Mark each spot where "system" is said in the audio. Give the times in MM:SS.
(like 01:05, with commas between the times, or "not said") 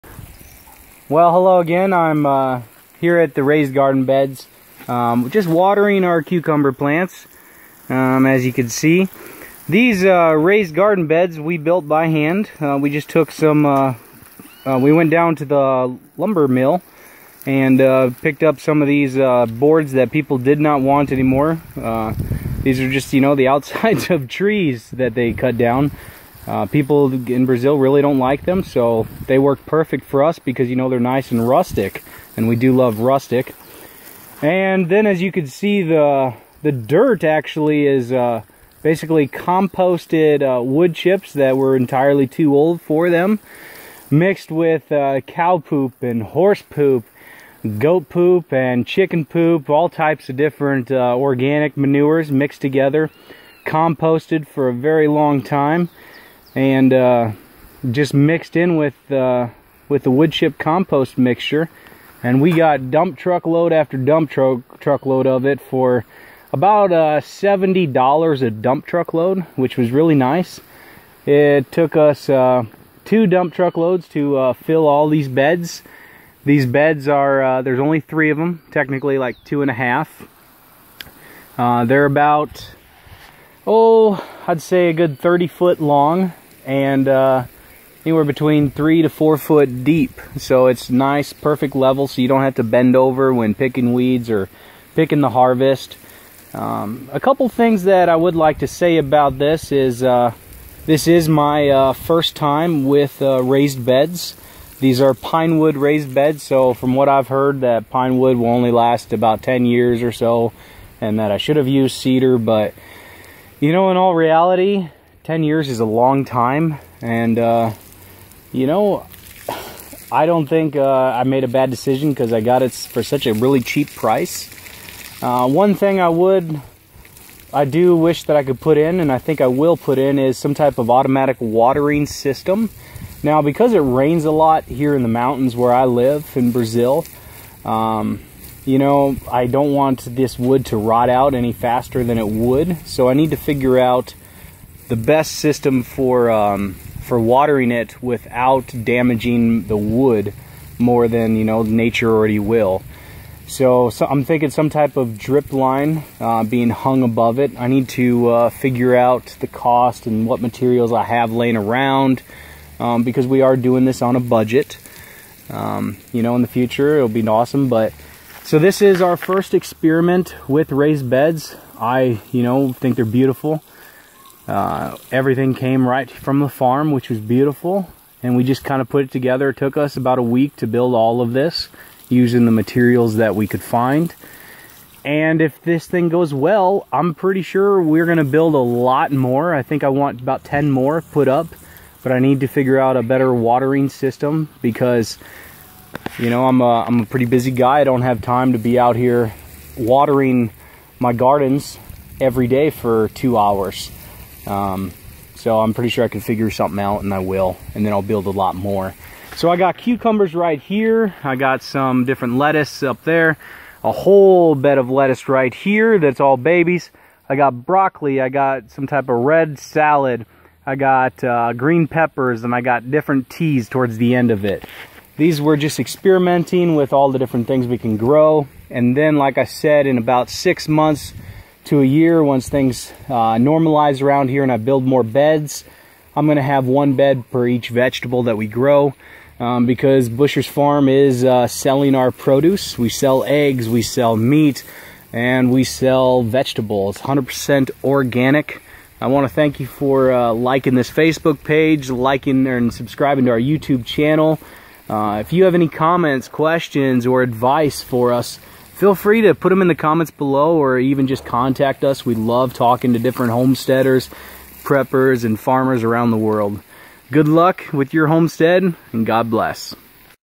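02:12, 02:25, 03:13.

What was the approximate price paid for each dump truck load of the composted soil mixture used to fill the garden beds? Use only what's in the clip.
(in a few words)
$70.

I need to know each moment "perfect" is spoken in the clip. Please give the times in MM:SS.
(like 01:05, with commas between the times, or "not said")
00:29, 01:31.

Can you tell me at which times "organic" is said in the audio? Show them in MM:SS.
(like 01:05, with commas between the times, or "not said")
00:51, 04:07.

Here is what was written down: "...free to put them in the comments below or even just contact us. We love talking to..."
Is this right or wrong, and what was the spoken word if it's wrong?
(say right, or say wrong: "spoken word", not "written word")
right.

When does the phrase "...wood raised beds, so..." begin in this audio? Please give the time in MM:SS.
01:45.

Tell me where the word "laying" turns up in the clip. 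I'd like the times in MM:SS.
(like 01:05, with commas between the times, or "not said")
02:41.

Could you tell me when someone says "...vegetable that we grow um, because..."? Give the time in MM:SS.
03:57.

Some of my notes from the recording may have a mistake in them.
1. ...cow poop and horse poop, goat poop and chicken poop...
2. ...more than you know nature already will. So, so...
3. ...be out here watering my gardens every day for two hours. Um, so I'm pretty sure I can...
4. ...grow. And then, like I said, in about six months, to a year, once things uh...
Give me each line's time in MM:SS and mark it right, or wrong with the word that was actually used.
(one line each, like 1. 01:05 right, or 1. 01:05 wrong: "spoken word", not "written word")
1. 00:45 right
2. 02:30 right
3. 03:18 right
4. 03:47 right.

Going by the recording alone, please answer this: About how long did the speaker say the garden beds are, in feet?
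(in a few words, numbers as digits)
30 feet.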